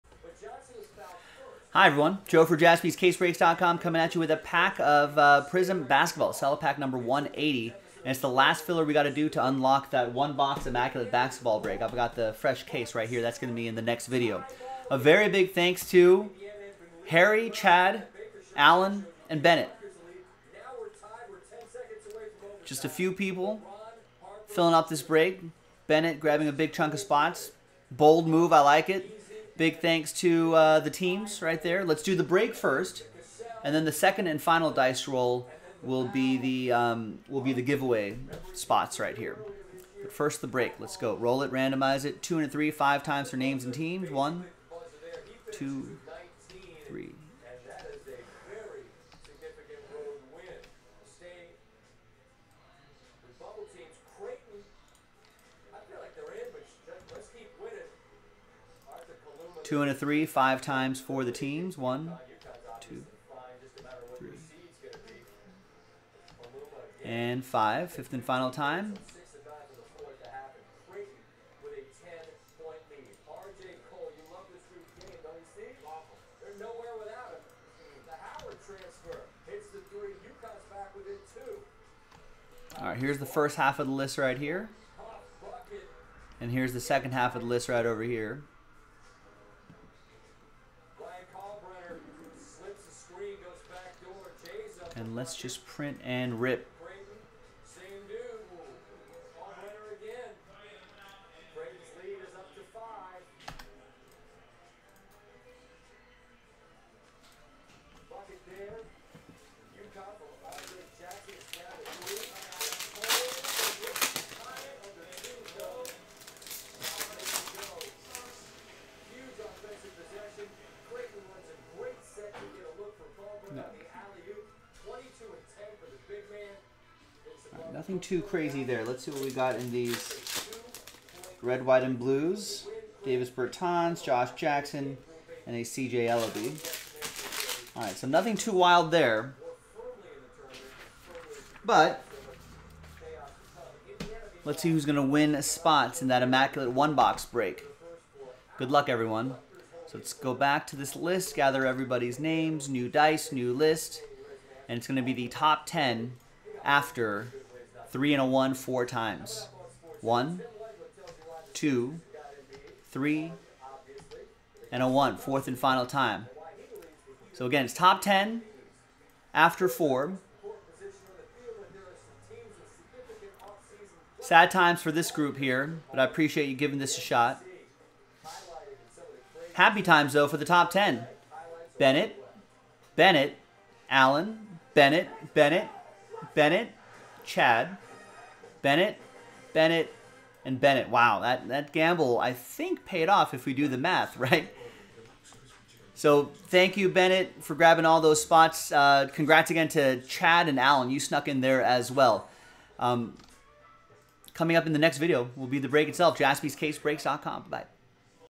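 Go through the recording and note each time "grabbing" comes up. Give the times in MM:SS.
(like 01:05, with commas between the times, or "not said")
00:26, 03:17.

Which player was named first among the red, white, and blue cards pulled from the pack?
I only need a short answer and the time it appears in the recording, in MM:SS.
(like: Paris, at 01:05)
Davis Bertans, at 02:13.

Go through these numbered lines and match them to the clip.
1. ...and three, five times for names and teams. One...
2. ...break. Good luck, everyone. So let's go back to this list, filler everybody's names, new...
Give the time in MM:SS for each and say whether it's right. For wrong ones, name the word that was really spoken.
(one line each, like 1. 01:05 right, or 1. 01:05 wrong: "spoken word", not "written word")
1. 00:42 right
2. 02:27 wrong: "gather", not "filler".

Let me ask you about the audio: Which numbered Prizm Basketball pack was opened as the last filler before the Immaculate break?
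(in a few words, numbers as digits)
180.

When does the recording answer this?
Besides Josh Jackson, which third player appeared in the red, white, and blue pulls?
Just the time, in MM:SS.
02:15.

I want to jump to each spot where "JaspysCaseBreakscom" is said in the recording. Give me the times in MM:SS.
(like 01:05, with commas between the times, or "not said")
00:02, 03:26.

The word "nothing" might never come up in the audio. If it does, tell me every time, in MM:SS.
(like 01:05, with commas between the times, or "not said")
02:07, 02:18.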